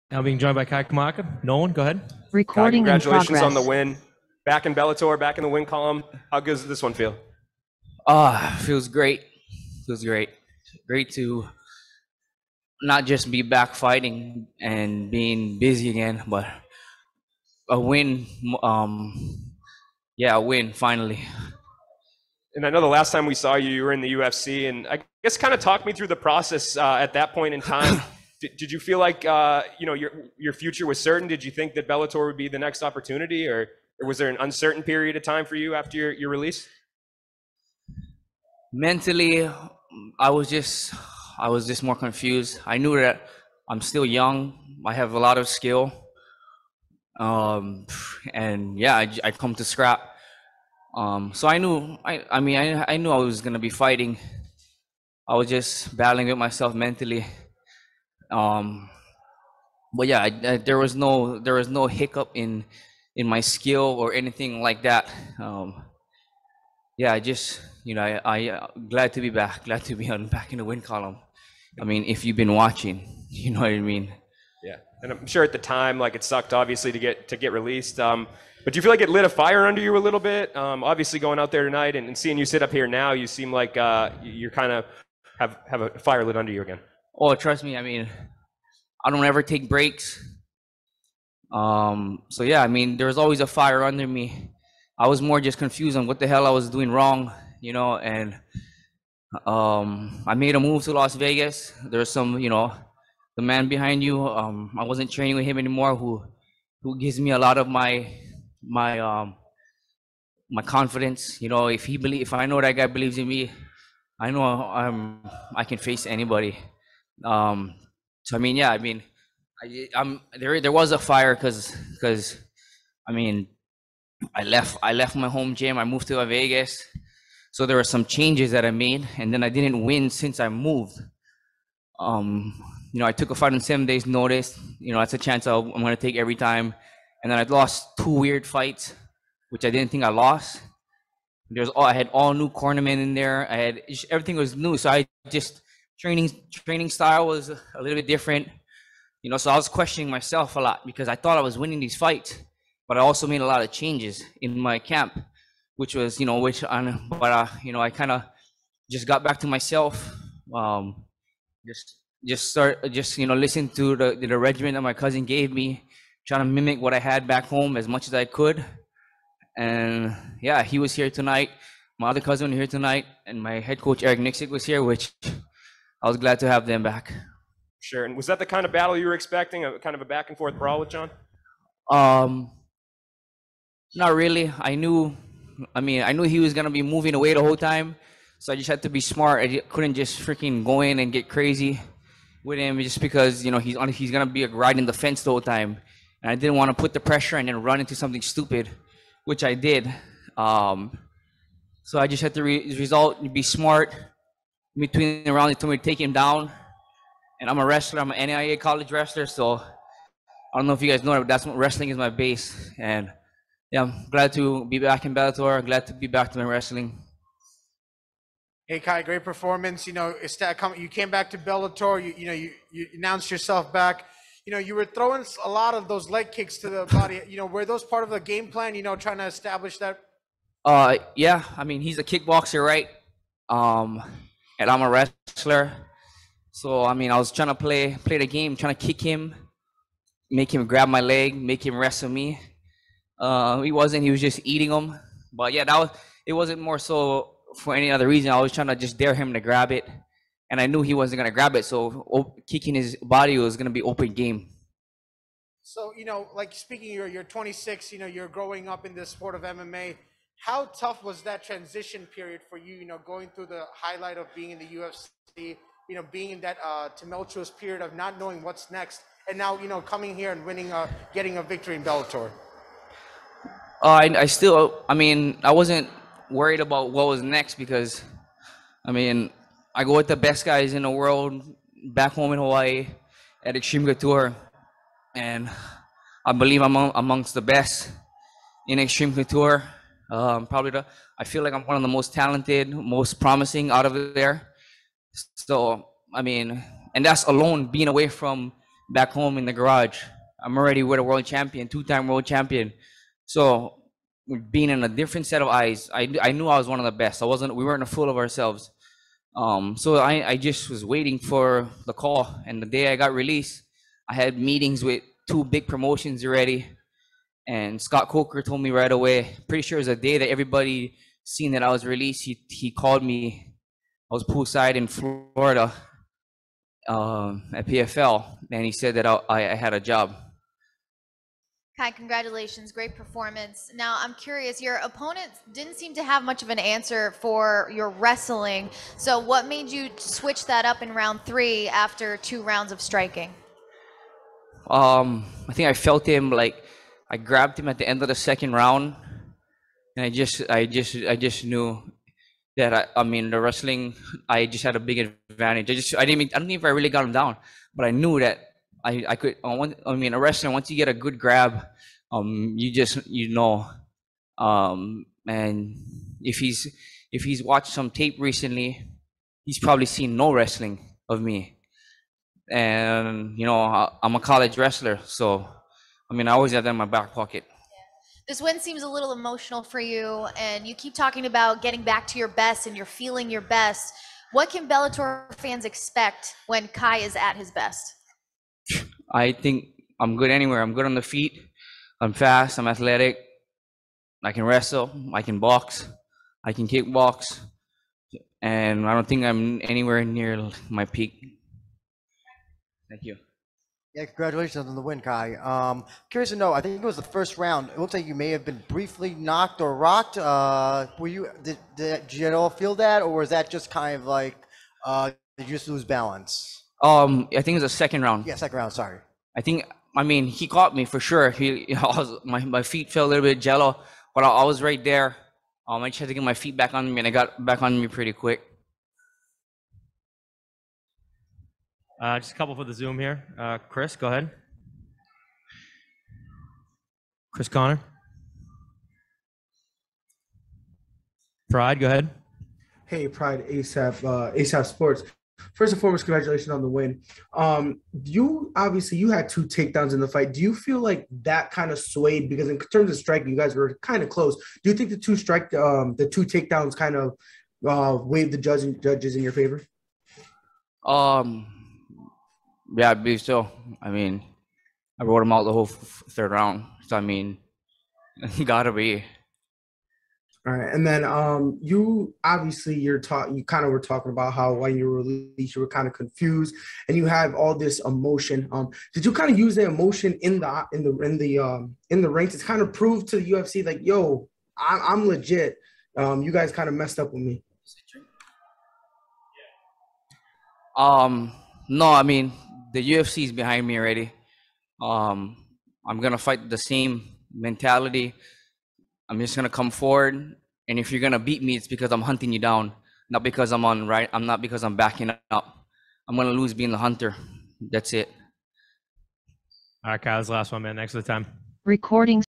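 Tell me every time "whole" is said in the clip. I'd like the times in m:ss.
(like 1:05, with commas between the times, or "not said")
3:07, 3:15, 7:45.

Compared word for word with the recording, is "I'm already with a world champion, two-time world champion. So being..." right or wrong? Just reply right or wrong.
right.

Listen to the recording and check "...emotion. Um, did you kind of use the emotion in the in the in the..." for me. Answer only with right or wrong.
right.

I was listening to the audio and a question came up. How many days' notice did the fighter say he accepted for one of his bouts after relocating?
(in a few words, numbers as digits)
7.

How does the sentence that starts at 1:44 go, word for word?
Um, I wasn't training with him anymore.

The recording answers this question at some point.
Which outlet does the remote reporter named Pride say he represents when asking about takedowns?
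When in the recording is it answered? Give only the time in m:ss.
7:24.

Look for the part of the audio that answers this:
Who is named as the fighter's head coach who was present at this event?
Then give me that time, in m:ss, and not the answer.
2:54.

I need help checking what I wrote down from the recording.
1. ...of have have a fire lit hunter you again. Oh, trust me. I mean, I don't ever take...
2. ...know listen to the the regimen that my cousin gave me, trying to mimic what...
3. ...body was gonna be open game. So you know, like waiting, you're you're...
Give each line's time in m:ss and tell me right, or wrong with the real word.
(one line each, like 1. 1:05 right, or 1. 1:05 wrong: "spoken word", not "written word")
1. 1:24 wrong: "under", not "hunter"
2. 2:43 right
3. 4:13 wrong: "speaking", not "waiting".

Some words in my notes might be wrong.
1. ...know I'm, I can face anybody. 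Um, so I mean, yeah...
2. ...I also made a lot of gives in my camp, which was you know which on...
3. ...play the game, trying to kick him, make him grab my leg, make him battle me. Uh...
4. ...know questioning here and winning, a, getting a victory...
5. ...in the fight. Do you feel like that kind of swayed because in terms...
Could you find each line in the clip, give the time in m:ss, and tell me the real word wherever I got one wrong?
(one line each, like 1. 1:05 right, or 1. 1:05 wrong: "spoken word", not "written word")
1. 1:54 right
2. 2:32 wrong: "changes", not "gives"
3. 3:58 wrong: "wrestle", not "battle"
4. 4:29 wrong: "coming", not "questioning"
5. 7:29 right.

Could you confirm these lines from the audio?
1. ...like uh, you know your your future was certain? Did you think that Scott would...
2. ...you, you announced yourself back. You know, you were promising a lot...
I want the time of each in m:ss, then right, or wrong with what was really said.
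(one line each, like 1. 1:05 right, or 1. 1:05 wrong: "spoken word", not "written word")
1. 0:28 wrong: "Bellator", not "Scott"
2. 3:42 wrong: "throwing", not "promising".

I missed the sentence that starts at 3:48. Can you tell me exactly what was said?
You know, trying to establish that.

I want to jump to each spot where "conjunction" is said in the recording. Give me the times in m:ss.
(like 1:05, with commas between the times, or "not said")
not said.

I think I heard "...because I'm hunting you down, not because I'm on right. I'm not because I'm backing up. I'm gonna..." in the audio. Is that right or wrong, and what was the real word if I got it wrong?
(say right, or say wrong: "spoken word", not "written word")
right.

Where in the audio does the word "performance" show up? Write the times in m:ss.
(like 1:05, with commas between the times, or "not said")
3:39, 5:32.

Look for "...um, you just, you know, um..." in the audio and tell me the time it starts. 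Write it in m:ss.
6:02.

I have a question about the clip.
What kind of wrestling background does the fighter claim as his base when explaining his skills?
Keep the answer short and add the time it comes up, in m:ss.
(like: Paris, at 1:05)
NIA college wrestler, at 3:28.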